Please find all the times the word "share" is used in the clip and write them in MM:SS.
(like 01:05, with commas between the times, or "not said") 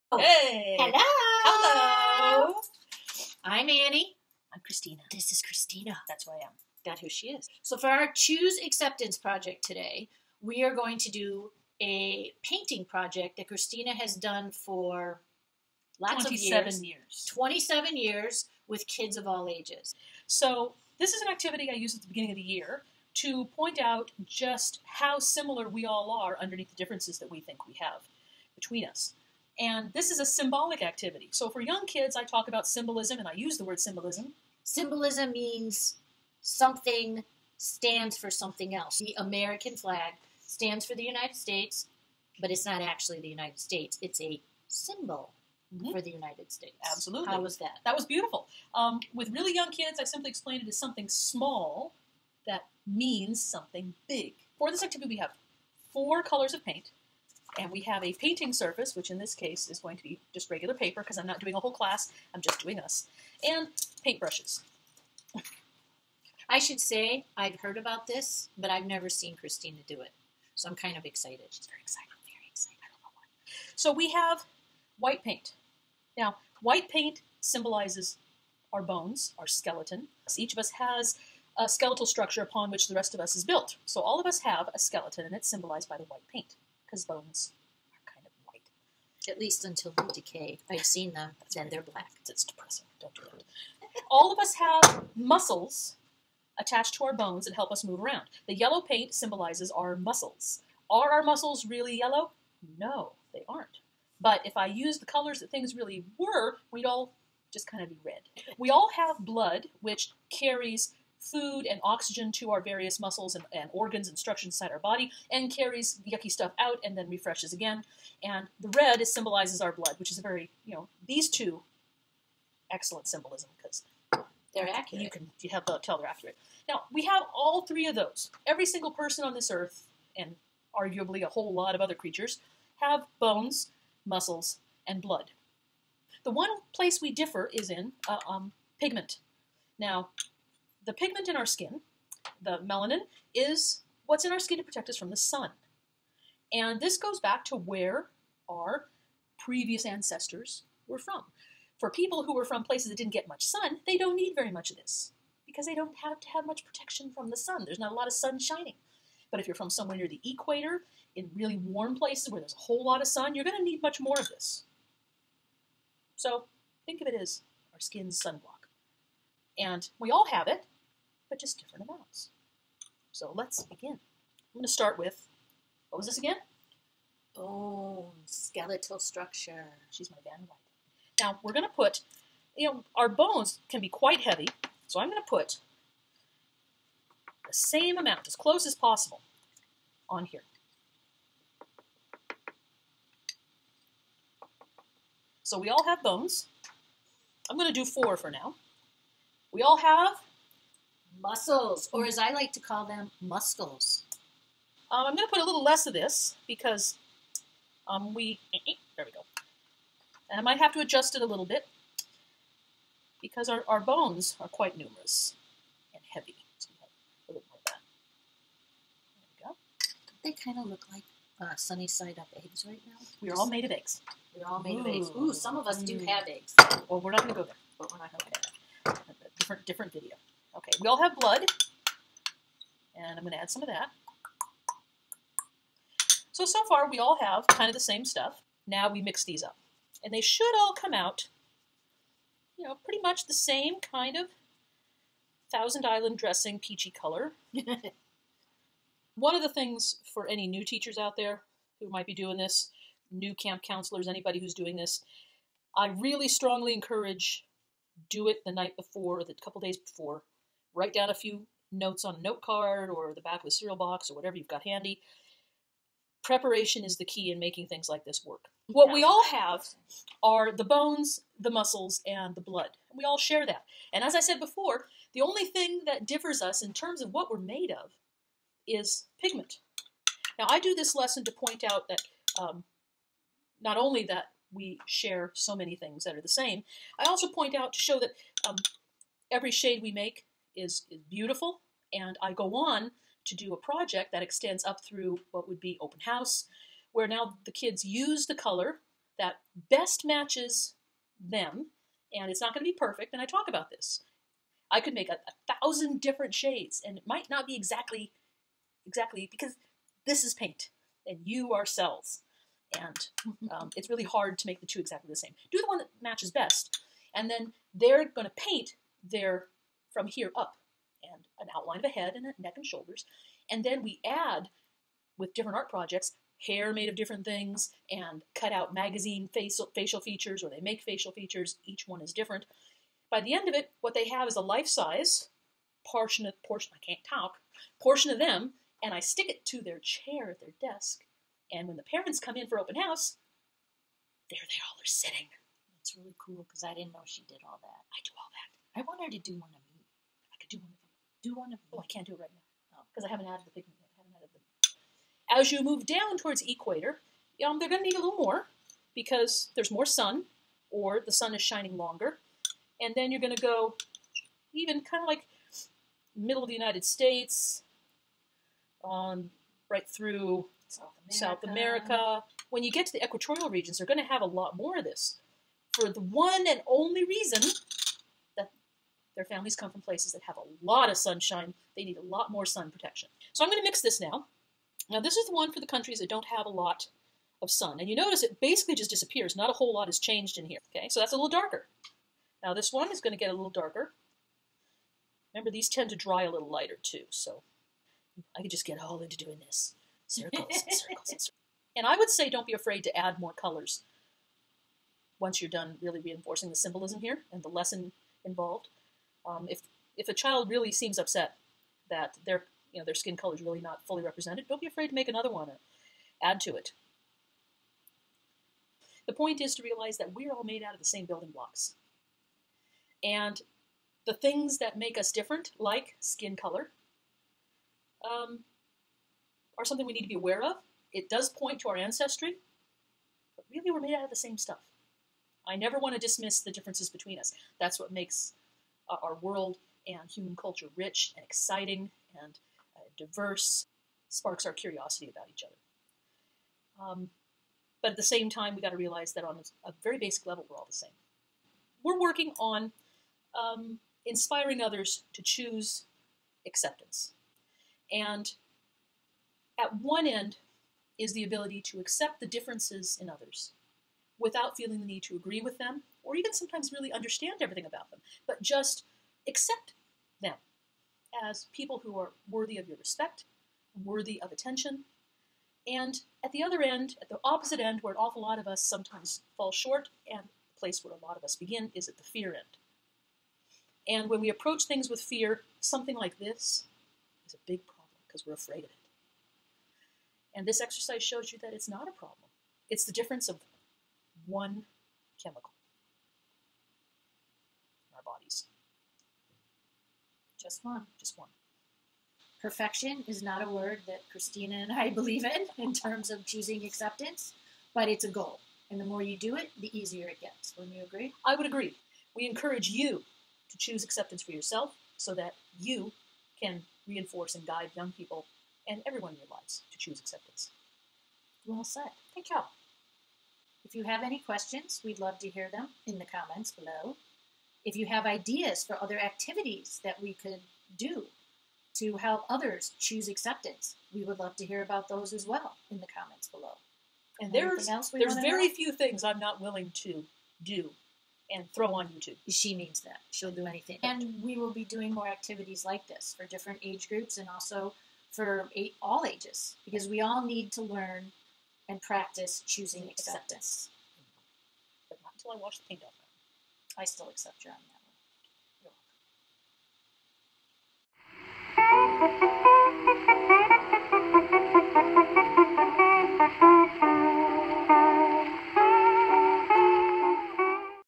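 04:33, 04:44.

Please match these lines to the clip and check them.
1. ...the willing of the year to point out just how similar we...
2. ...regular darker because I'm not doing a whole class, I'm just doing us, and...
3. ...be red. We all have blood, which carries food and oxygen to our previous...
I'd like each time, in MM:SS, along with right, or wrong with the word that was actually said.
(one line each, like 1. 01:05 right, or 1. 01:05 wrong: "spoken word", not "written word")
1. 00:22 wrong: "beginning", not "willing"
2. 01:00 wrong: "paper", not "darker"
3. 01:47 wrong: "various", not "previous".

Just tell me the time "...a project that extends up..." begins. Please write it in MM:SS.
04:53.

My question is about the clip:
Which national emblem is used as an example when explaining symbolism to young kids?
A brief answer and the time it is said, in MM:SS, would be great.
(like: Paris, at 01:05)
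The American flag, at 00:38.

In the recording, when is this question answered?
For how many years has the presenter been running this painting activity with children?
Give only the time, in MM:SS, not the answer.
00:17.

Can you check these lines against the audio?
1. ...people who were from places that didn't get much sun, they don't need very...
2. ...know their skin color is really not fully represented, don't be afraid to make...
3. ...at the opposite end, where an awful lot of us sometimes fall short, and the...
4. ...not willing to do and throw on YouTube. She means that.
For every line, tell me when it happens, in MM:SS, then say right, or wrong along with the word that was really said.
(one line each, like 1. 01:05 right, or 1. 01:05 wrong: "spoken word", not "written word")
1. 02:31 right
2. 06:52 right
3. 07:57 right
4. 08:59 right.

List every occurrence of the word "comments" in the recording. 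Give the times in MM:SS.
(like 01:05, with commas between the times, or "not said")
08:46, 08:55.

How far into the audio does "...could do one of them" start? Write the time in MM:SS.
05:50.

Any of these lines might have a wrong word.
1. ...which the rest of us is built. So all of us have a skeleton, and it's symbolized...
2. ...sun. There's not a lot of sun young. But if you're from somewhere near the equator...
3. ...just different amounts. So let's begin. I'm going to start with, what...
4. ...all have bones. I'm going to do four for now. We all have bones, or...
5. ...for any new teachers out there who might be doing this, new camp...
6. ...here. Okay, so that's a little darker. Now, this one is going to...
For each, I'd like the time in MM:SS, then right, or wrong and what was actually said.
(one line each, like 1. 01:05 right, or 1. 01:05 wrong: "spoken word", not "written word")
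1. 01:22 right
2. 02:37 wrong: "shining", not "young"
3. 02:51 right
4. 03:15 wrong: "muscles", not "bones"
5. 04:10 right
6. 06:30 right.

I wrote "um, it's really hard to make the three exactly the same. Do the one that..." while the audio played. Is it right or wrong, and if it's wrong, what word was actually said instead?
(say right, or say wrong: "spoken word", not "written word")
wrong: "two", not "three".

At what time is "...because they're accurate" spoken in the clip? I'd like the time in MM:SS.
02:03.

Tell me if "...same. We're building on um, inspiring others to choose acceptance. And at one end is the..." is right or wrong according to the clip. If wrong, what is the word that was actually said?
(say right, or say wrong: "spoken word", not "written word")
wrong: "working", not "building".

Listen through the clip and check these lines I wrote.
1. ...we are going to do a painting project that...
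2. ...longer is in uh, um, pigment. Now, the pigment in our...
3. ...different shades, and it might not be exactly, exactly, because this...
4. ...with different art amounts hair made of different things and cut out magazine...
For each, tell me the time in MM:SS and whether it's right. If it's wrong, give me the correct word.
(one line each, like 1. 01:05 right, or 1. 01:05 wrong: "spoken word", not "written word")
1. 00:10 right
2. 02:17 wrong: "differ", not "longer"
3. 05:06 right
4. 05:25 wrong: "projects", not "amounts".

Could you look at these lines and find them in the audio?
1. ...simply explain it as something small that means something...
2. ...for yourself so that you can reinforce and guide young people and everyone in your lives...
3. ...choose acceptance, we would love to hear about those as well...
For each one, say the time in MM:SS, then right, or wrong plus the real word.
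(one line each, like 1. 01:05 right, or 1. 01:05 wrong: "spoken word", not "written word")
1. 00:50 right
2. 08:34 right
3. 08:52 right.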